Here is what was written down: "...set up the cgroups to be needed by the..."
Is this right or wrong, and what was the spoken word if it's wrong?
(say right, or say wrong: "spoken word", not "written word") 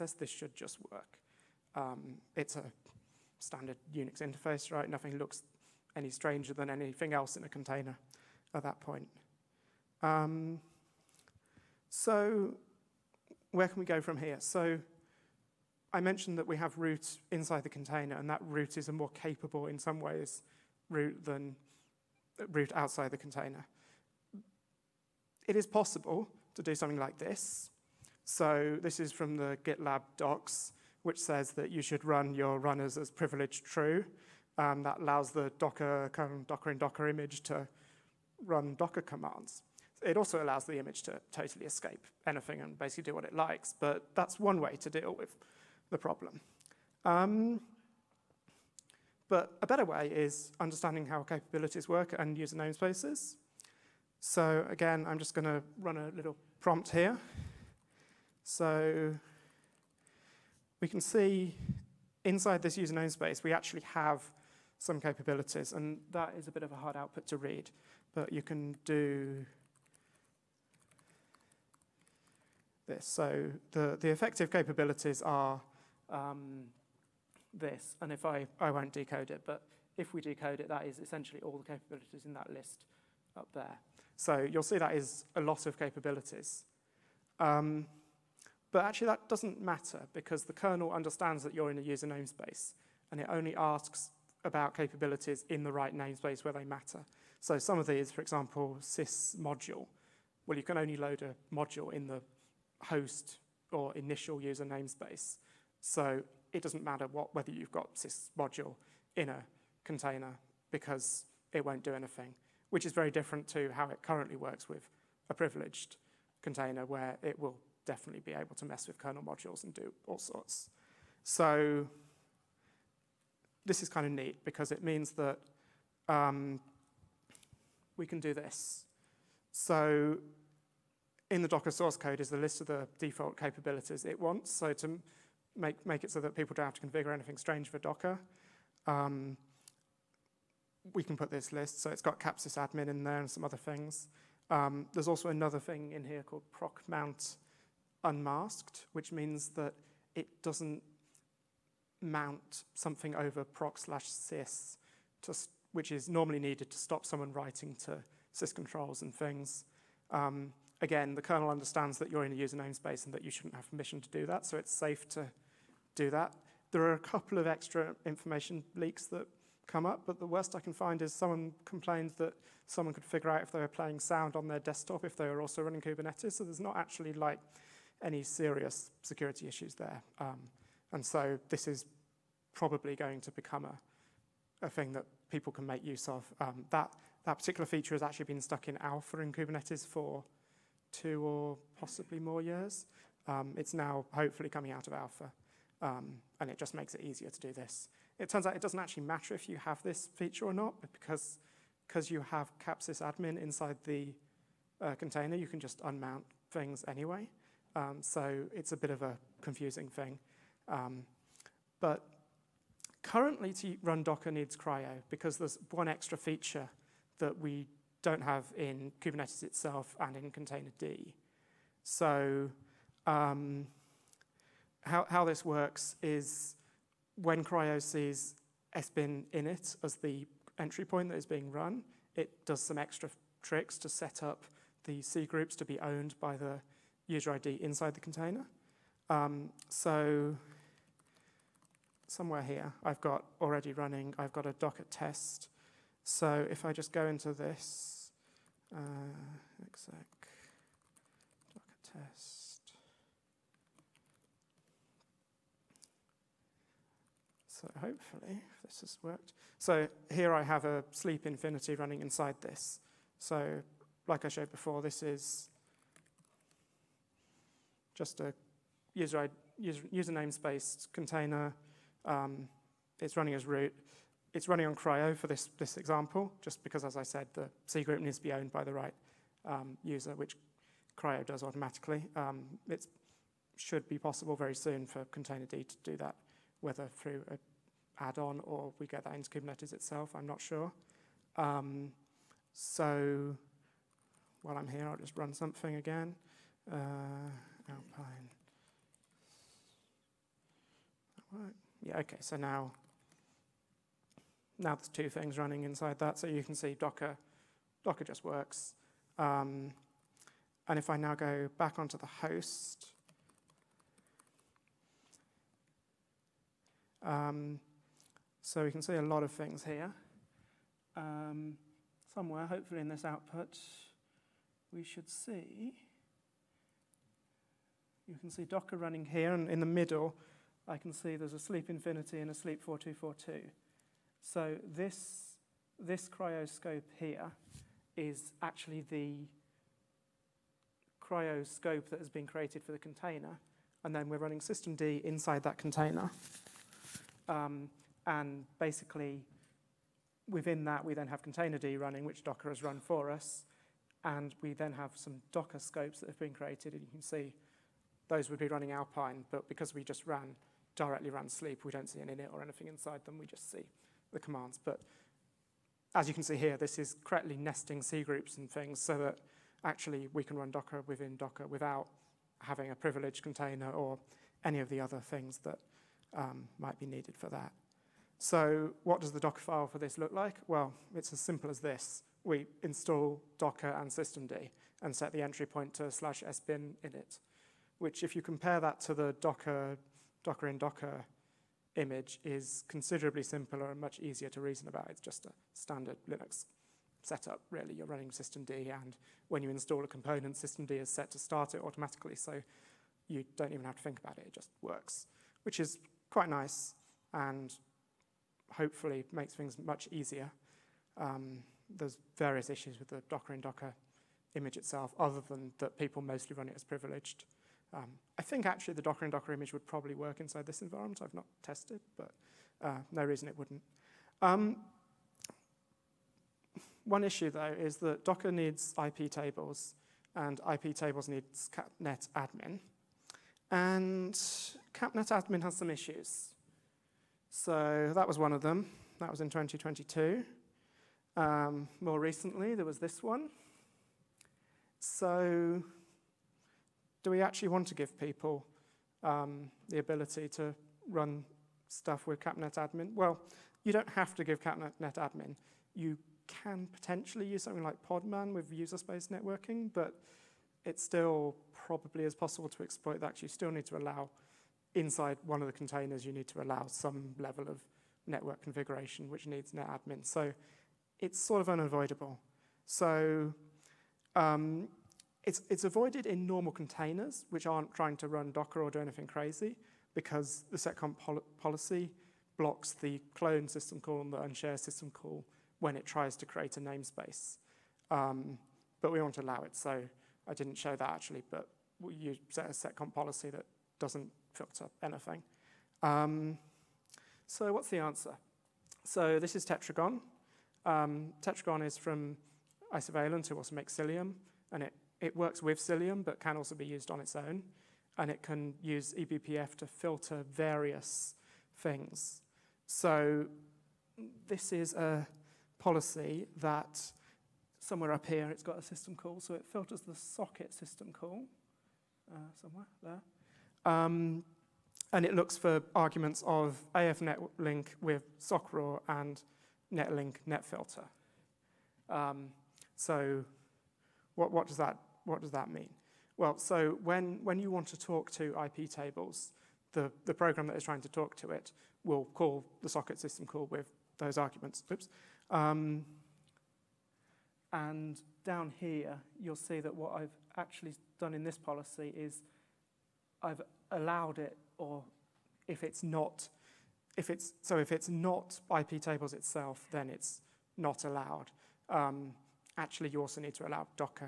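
wrong: "owned", not "needed".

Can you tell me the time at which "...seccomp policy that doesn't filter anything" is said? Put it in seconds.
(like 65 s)
492 s.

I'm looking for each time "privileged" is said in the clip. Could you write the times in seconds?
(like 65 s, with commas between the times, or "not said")
33 s, 115 s, 372 s, 416 s.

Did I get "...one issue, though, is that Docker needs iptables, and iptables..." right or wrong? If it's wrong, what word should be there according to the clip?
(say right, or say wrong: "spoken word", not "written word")
right.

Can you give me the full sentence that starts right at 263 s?
So like I showed before, this is just a user, user, user namespace container.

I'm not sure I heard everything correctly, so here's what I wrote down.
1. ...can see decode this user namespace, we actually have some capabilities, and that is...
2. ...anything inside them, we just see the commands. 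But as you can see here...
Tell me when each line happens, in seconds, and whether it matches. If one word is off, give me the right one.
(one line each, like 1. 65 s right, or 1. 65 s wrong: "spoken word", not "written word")
1. 60 s wrong: "inside", not "decode"
2. 362 s right.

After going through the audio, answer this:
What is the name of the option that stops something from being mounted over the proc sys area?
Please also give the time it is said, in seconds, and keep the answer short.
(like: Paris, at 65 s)
proc mount unmasked, at 146 s.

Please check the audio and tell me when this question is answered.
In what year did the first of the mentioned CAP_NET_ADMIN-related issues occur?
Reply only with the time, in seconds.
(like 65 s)
439 s.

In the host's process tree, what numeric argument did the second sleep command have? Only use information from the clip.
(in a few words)
4242.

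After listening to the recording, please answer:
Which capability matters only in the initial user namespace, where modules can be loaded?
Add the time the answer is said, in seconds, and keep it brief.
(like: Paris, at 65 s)
sys module, at 98 s.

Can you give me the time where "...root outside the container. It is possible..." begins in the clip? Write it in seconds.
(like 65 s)
22 s.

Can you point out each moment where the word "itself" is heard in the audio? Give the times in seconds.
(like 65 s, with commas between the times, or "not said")
219 s, 289 s, 414 s, 559 s.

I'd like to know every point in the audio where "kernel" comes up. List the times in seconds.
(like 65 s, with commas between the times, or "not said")
90 s, 118 s, 161 s.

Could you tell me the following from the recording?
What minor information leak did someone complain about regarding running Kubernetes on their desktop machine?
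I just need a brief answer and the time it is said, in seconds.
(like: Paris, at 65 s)
playing sound, at 173 s.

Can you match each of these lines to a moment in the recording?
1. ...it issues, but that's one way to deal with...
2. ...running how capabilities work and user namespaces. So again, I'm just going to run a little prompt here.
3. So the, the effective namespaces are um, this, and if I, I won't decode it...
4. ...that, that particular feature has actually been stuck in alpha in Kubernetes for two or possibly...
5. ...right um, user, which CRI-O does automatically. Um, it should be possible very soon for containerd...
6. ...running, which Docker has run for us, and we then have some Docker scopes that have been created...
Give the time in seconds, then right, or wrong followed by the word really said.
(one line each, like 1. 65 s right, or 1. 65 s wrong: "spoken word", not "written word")
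1. 43 s wrong: "likes", not "issues"
2. 50 s wrong: "understanding", not "running"
3. 73 s wrong: "capabilities", not "namespaces"
4. 186 s right
5. 278 s right
6. 351 s right.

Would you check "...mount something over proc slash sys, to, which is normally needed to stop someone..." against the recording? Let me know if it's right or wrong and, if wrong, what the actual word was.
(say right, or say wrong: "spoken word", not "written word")
right.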